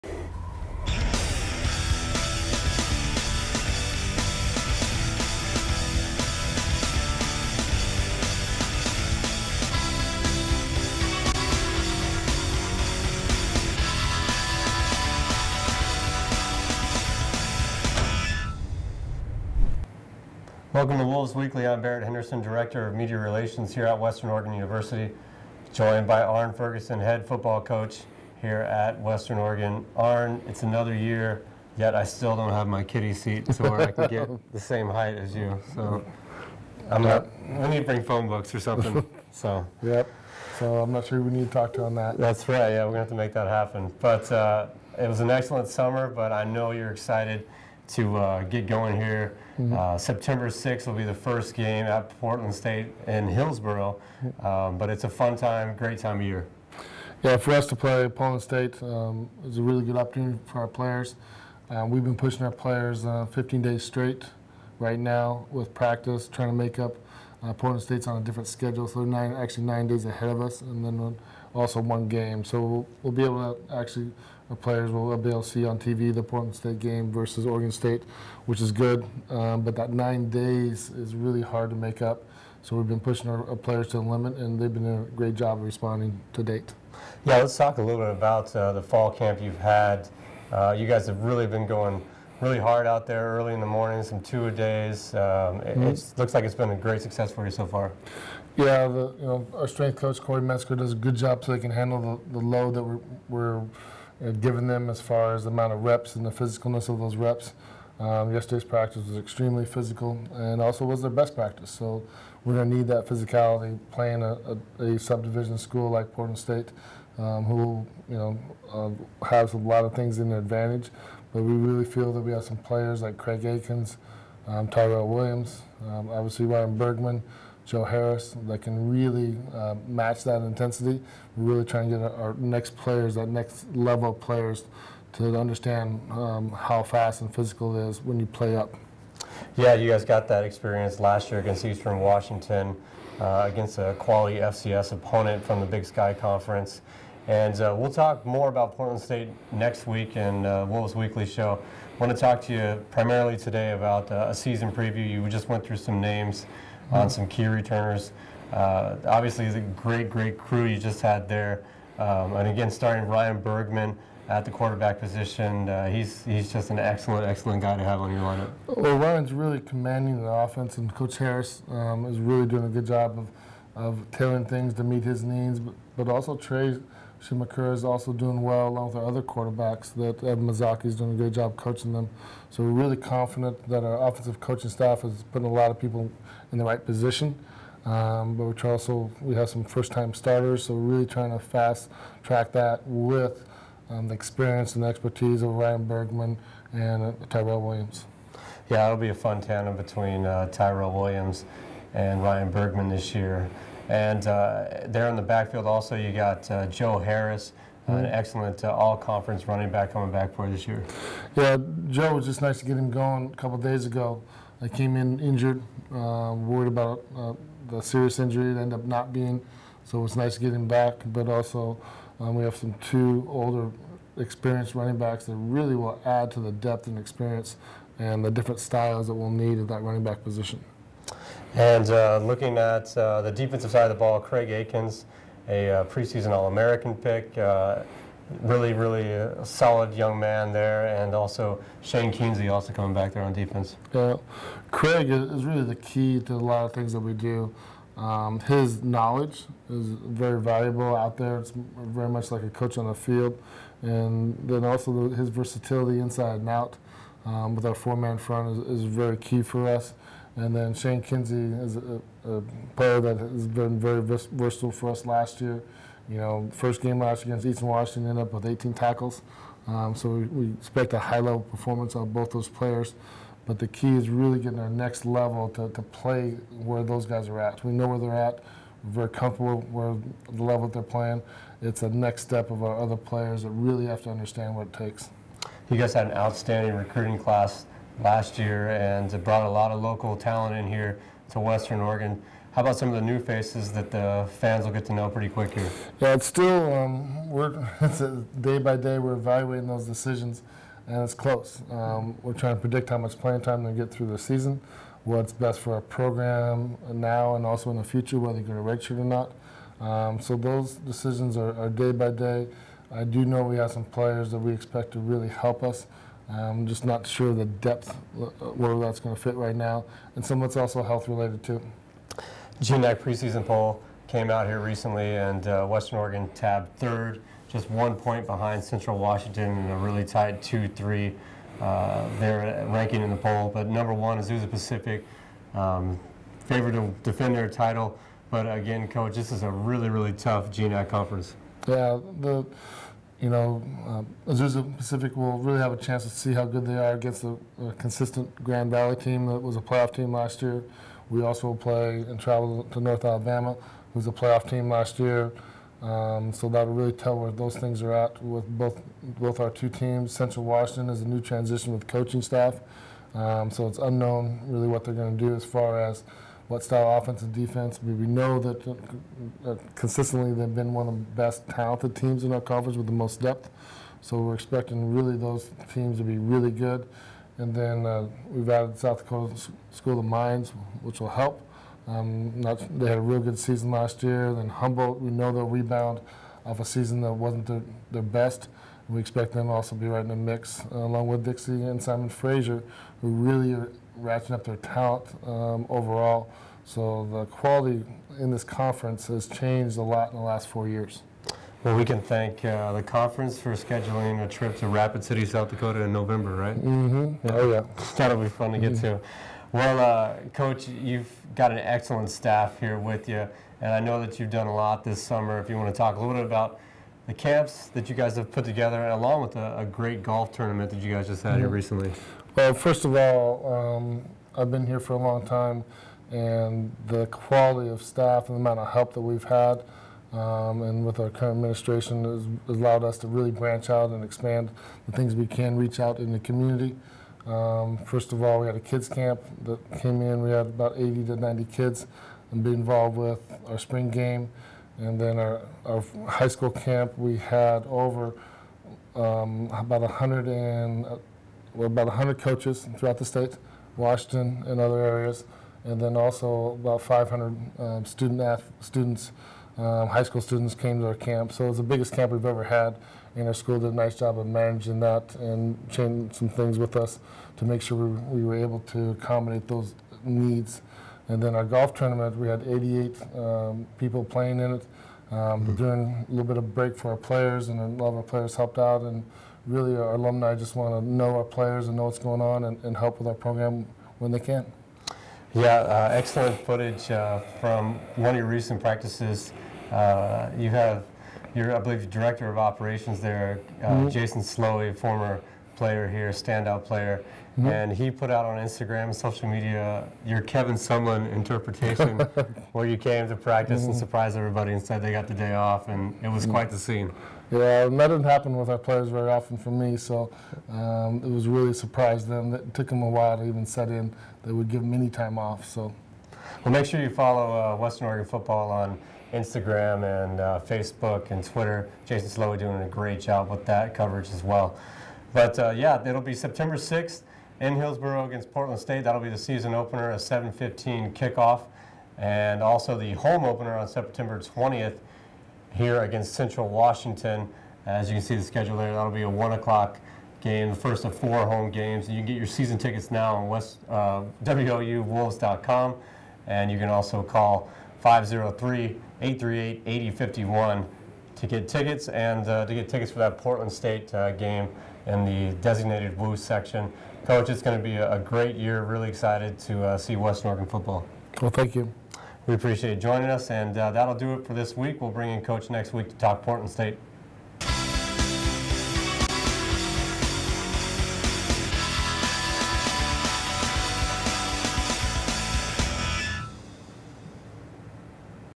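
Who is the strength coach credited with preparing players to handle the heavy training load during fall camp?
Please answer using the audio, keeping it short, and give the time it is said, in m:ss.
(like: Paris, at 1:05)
Corey Metzger, at 1:40.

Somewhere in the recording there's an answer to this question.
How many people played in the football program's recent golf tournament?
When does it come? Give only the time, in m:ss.
7:52.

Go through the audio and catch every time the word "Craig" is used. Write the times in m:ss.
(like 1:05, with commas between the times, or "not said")
2:03, 3:54, 4:04.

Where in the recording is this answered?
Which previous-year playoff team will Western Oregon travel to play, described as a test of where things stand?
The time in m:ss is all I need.
5:52.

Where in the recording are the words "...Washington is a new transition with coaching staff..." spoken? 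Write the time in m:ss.
6:00.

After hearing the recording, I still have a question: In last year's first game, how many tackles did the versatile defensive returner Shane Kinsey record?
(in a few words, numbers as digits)
18.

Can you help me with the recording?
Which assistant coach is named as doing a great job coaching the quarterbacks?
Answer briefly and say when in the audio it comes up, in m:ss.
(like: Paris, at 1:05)
Ed Mizaki, at 3:00.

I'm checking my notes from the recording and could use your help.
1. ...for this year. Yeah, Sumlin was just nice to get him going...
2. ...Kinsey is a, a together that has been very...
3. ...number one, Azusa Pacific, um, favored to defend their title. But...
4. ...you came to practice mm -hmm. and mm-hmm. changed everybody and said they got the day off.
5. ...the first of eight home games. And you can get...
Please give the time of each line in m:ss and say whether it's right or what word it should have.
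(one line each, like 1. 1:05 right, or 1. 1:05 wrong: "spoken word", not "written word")
1. 3:30 wrong: "Joe", not "Sumlin"
2. 4:21 wrong: "player", not "together"
3. 5:33 right
4. 8:22 wrong: "surprised", not "changed"
5. 9:00 wrong: "four", not "eight".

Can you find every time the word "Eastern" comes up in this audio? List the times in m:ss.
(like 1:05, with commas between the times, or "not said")
2:21, 4:27.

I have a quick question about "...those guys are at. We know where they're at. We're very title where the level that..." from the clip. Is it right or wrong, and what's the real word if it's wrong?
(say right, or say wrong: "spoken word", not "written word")
wrong: "comfortable", not "title".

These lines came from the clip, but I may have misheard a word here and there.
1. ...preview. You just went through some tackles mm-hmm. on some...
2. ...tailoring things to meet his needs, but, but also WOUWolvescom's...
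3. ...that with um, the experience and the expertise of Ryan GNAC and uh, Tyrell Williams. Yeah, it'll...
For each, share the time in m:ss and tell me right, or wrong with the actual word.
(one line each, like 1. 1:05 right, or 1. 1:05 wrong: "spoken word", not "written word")
1. 2:34 wrong: "names", not "tackles"
2. 2:54 wrong: "Trey", not "WOUWolvescom"
3. 3:12 wrong: "Bergman", not "GNAC".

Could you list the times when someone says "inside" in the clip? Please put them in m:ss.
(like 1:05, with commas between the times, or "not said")
4:15.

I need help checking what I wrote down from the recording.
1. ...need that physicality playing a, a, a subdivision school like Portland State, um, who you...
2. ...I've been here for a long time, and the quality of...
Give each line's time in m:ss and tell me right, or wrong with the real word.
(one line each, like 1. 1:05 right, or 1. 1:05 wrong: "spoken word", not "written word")
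1. 1:52 right
2. 7:04 right.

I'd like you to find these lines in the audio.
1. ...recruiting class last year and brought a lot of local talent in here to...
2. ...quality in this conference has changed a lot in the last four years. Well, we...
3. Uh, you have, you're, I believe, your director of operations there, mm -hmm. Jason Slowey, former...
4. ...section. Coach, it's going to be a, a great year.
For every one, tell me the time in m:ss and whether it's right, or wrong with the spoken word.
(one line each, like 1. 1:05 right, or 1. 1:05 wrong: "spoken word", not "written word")
1. 4:46 right
2. 6:37 right
3. 8:09 right
4. 9:16 right.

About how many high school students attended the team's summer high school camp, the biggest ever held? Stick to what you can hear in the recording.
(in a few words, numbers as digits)
500.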